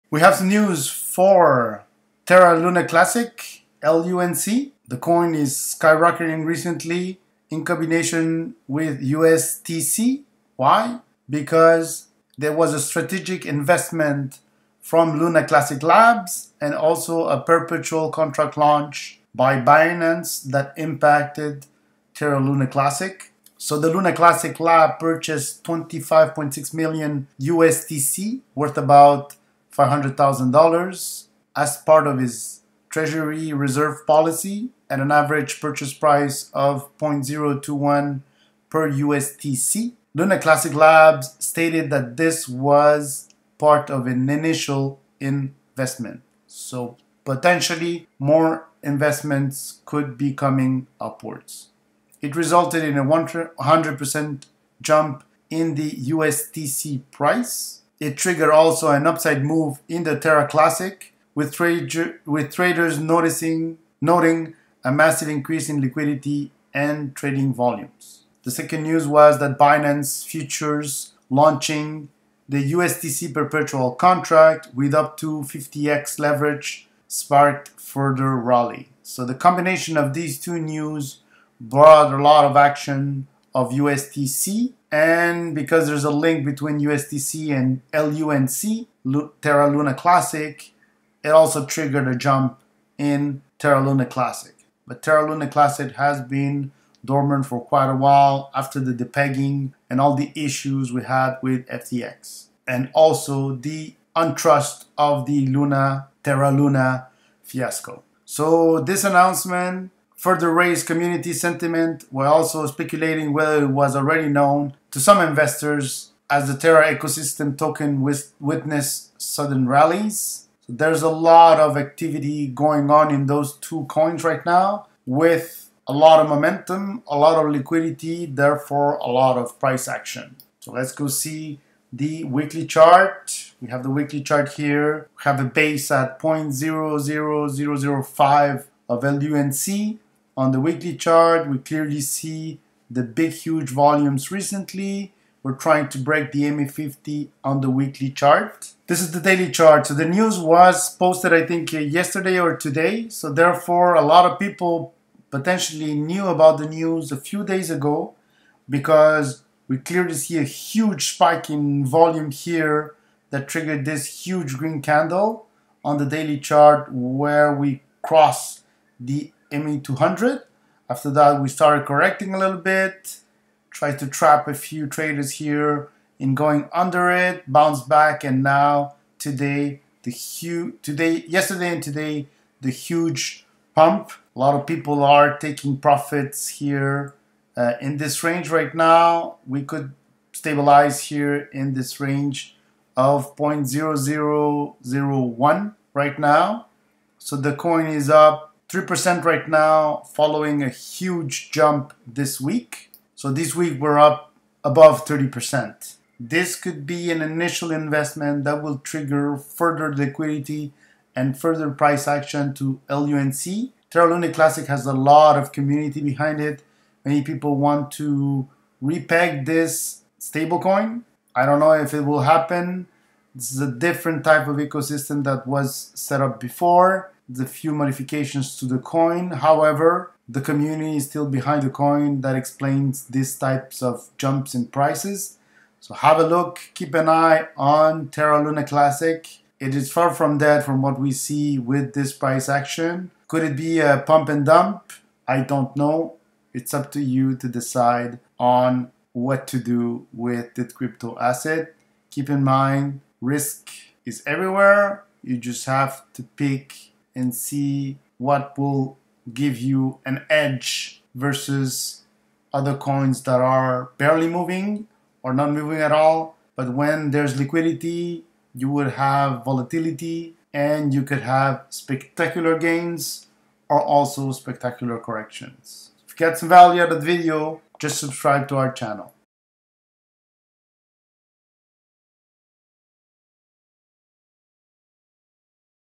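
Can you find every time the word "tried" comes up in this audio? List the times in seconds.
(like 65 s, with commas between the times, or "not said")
173 s.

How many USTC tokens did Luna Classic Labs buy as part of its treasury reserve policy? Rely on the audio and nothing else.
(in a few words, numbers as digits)
25.6 million.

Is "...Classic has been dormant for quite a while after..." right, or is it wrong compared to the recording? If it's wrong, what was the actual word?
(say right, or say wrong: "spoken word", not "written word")
right.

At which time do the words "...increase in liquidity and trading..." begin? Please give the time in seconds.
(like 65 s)
65 s.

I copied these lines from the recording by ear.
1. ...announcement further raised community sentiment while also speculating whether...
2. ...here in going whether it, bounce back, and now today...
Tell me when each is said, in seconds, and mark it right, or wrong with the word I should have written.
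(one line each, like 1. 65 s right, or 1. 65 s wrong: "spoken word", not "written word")
1. 109 s right
2. 175 s wrong: "under", not "whether".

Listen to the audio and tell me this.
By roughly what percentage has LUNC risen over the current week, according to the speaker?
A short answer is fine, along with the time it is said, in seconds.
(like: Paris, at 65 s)
30%, at 205 s.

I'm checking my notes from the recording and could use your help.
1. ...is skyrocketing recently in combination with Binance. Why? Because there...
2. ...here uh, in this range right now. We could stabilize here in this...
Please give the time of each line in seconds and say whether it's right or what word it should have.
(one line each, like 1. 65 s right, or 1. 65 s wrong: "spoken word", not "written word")
1. 5 s wrong: "USTC", not "Binance"
2. 186 s right.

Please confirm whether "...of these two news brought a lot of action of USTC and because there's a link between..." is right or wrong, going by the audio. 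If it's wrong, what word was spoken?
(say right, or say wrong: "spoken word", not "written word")
right.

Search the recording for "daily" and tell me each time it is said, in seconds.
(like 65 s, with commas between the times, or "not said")
149 s, 166 s.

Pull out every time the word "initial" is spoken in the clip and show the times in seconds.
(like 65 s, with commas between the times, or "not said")
44 s, 207 s.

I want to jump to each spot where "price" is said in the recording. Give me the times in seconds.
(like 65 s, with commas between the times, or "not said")
35 s, 57 s, 129 s, 211 s, 234 s, 242 s.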